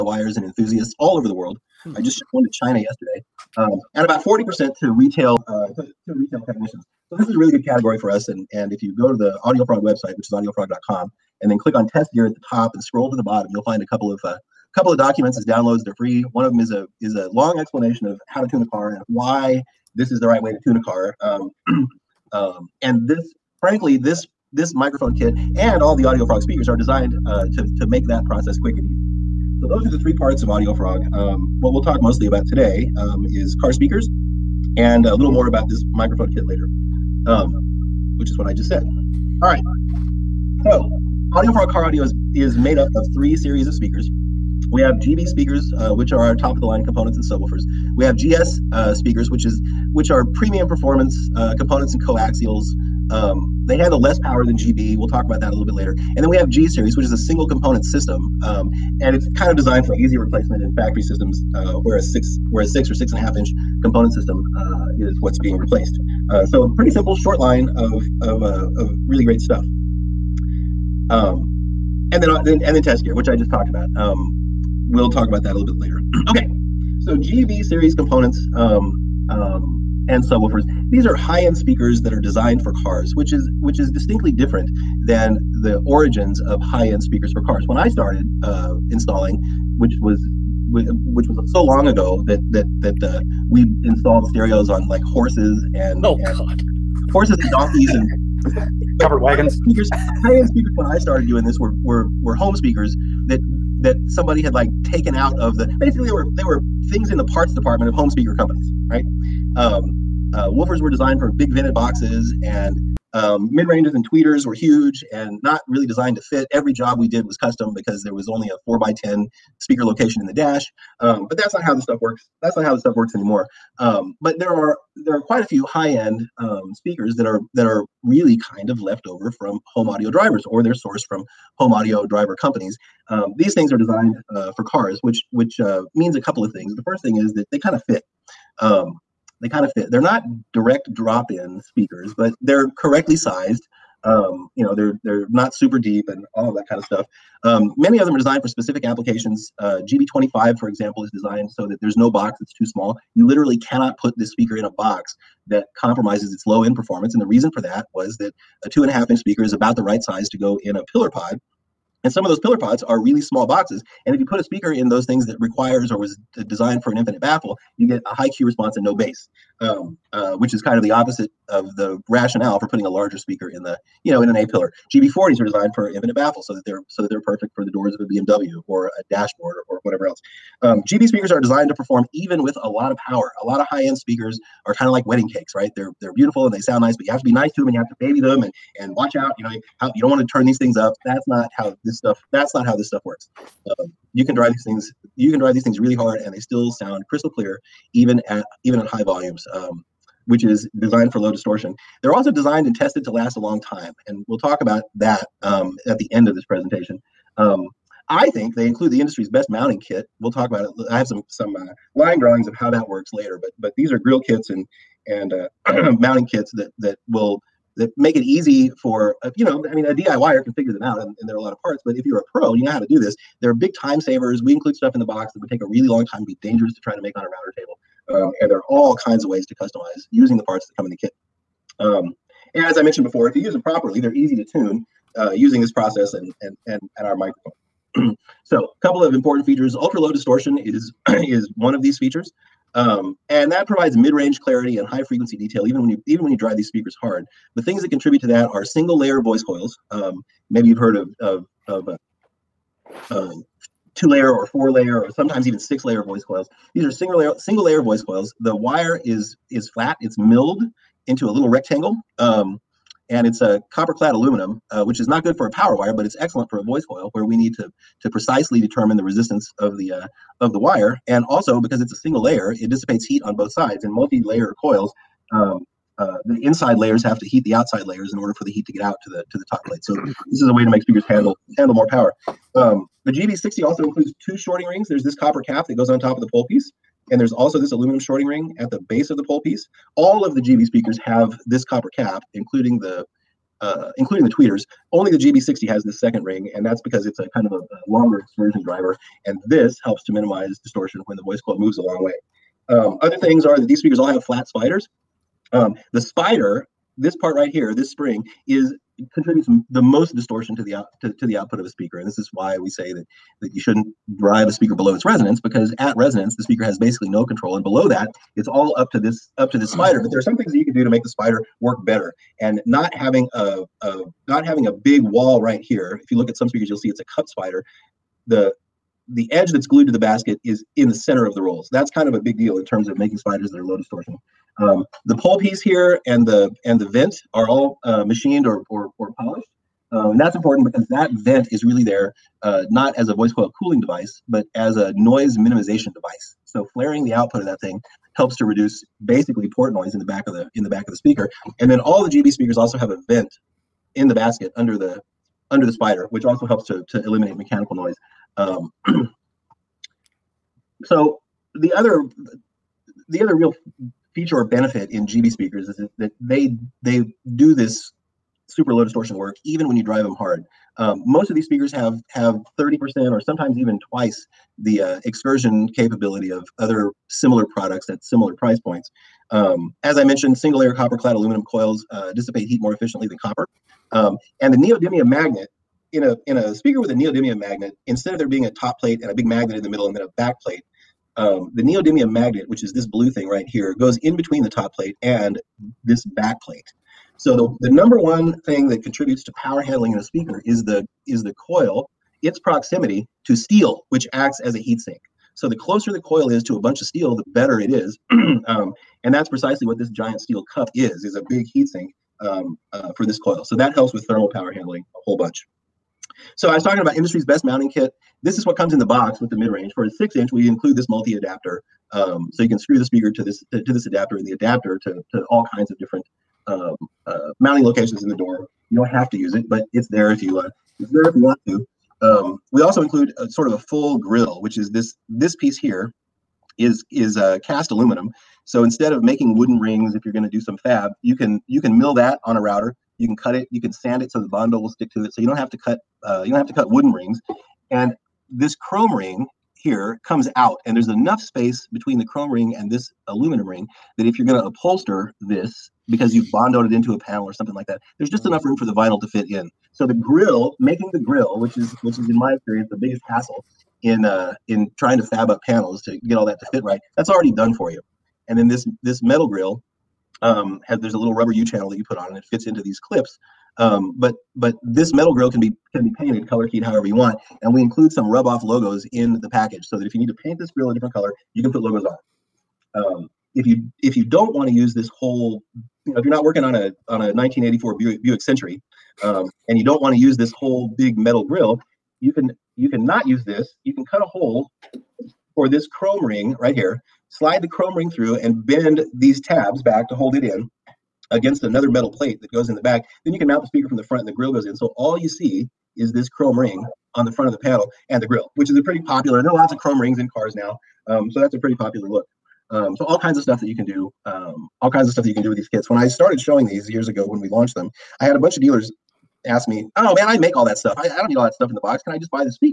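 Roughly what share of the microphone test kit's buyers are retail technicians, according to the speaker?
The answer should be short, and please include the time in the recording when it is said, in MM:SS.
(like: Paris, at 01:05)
40%, at 00:04.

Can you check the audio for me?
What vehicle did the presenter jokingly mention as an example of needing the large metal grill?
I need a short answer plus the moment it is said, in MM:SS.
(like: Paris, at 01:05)
1984 Buick Century, at 08:07.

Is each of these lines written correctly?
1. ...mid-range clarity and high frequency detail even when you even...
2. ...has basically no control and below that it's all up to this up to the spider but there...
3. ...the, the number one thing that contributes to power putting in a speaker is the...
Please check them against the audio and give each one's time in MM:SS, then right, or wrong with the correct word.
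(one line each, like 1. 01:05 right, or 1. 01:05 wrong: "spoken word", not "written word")
1. 04:03 right
2. 05:16 right
3. 06:37 wrong: "handling", not "putting".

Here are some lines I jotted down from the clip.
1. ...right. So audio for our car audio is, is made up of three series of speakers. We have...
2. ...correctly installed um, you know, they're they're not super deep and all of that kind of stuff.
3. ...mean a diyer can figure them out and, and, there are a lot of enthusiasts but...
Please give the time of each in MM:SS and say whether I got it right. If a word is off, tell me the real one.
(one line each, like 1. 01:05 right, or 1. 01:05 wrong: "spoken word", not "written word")
1. 00:39 right
2. 02:22 wrong: "sized", not "installed"
3. 03:39 wrong: "parts", not "enthusiasts".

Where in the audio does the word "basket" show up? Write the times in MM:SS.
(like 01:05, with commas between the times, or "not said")
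05:29, 05:54.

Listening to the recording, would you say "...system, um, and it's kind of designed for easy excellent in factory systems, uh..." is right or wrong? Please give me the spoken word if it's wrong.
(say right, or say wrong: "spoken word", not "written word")
wrong: "replacement", not "excellent".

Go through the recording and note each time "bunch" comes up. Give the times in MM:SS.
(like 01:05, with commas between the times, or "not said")
06:46, 06:55, 08:38.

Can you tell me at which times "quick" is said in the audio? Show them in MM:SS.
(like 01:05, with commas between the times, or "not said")
00:28.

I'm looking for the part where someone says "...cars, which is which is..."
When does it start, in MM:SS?
01:22.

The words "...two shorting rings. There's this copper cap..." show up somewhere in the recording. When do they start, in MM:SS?
04:44.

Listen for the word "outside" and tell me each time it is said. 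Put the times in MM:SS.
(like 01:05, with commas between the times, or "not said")
04:37.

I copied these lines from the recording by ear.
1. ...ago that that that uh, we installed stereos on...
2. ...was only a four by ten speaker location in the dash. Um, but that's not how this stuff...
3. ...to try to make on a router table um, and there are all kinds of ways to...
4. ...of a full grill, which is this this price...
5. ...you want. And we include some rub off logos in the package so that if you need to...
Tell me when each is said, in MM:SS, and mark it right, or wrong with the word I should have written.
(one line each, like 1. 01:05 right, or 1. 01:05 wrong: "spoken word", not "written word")
1. 01:31 right
2. 01:58 right
3. 03:46 right
4. 07:13 wrong: "piece", not "price"
5. 07:56 right.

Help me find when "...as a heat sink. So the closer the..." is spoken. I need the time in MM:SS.
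06:44.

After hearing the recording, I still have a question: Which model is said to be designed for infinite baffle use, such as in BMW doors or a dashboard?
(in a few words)
GB40.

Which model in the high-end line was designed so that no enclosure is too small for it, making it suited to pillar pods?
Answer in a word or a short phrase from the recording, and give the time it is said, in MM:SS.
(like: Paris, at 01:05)
GB25, at 02:29.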